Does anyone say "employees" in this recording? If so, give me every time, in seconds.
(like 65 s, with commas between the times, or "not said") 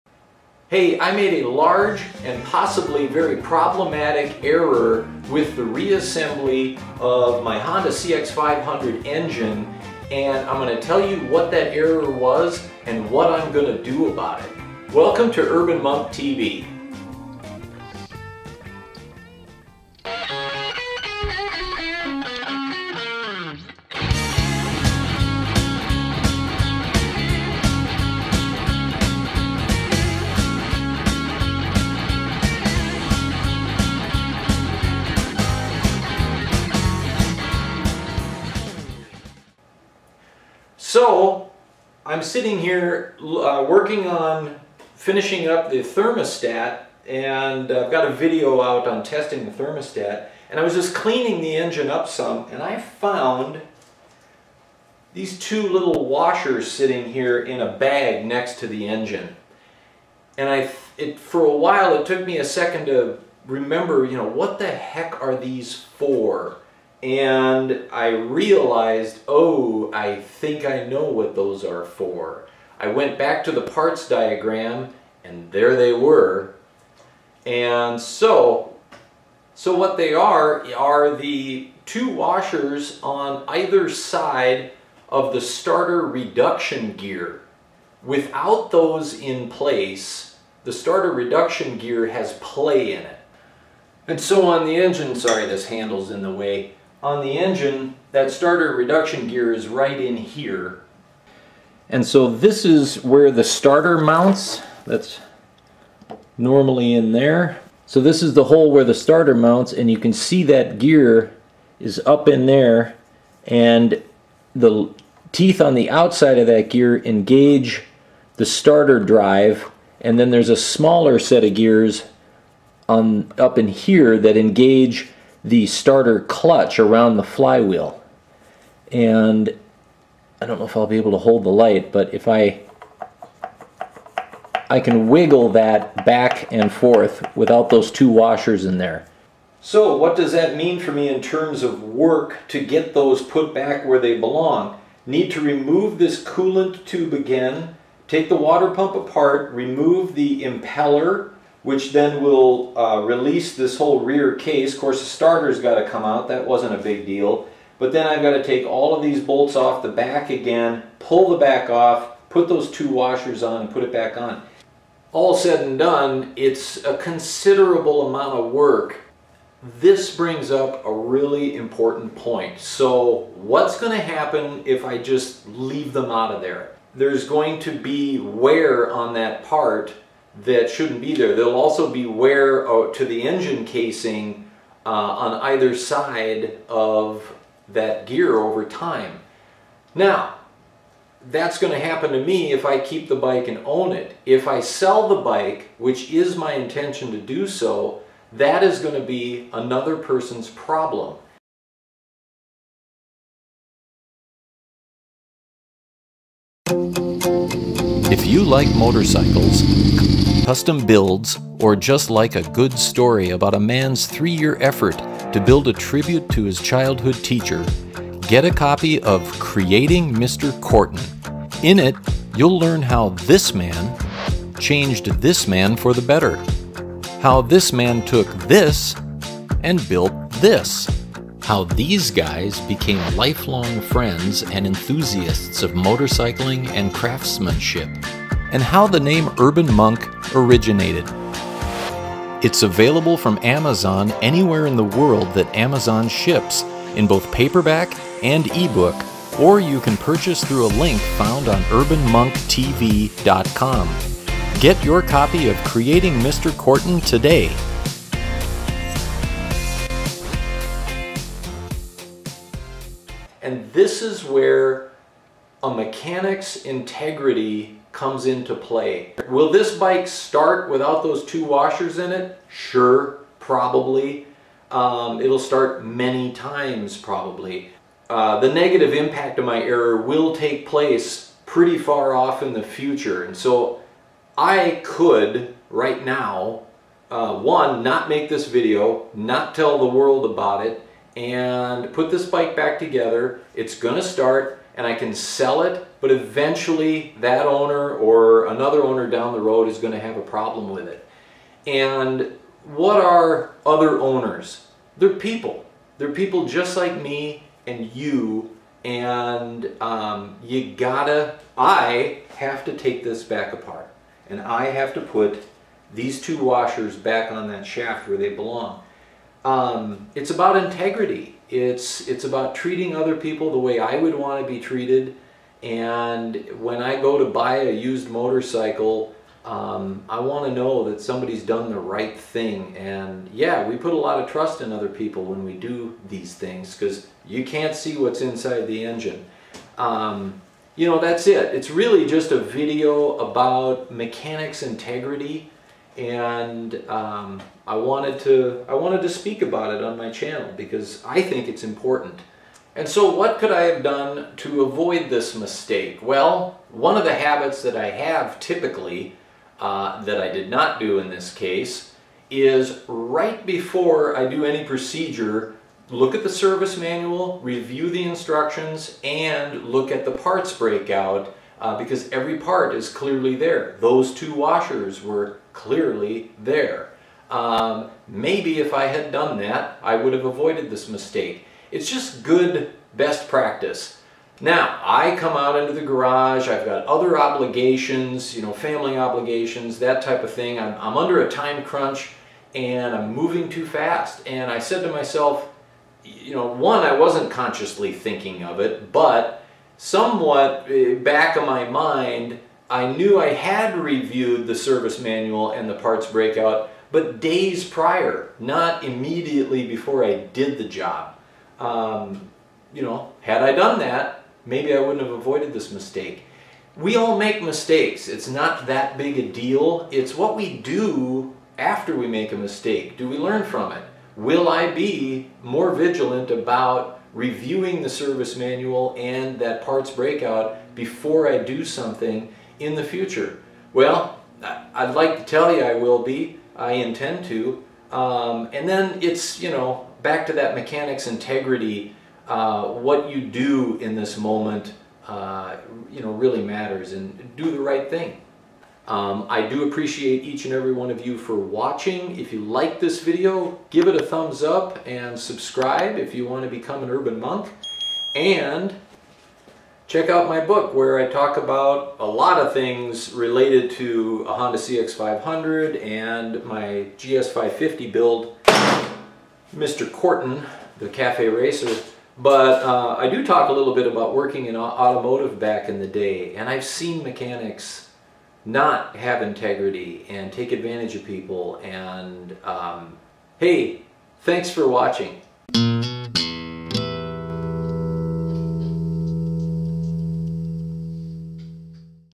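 not said.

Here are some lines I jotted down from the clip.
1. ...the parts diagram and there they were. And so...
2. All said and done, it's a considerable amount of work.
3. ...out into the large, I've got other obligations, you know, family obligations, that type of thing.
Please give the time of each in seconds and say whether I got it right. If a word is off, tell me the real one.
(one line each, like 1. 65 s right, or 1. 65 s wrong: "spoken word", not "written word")
1. 73 s right
2. 165 s right
3. 385 s wrong: "garage", not "large".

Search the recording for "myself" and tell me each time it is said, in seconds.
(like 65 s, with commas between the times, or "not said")
394 s.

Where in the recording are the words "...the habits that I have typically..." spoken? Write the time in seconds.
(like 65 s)
357 s.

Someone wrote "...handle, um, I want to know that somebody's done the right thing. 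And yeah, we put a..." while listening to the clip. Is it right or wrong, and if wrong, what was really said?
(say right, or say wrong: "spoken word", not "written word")
wrong: "motorcycle", not "handle".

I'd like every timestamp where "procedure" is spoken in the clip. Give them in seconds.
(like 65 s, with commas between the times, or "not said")
364 s.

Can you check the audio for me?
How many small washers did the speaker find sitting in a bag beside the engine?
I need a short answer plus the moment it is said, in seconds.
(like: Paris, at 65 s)
2, at 55 s.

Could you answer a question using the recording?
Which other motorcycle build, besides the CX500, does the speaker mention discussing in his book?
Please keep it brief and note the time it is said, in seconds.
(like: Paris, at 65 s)
GS550, at 466 s.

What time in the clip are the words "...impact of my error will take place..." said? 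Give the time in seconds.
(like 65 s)
278 s.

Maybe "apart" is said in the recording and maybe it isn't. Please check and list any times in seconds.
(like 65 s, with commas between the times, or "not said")
148 s, 313 s.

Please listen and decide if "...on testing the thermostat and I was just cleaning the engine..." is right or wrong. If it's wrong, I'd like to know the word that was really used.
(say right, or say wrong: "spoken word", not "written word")
right.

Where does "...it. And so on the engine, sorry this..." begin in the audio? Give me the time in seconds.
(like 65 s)
93 s.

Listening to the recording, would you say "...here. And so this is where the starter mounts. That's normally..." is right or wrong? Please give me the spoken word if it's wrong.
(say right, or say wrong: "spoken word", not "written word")
right.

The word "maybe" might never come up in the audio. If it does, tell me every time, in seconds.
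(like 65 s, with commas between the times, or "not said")
378 s, 414 s.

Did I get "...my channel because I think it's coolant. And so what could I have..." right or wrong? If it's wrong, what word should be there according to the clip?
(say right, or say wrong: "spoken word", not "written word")
wrong: "important", not "coolant".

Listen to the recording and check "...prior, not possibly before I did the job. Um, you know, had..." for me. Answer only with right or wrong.
wrong.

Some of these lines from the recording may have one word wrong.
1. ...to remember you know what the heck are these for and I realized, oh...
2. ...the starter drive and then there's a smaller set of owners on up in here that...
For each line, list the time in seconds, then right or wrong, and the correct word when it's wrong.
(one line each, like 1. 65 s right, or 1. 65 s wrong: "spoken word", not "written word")
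1. 62 s right
2. 118 s wrong: "gears", not "owners".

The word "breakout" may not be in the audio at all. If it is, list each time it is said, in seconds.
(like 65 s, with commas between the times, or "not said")
370 s, 406 s, 429 s.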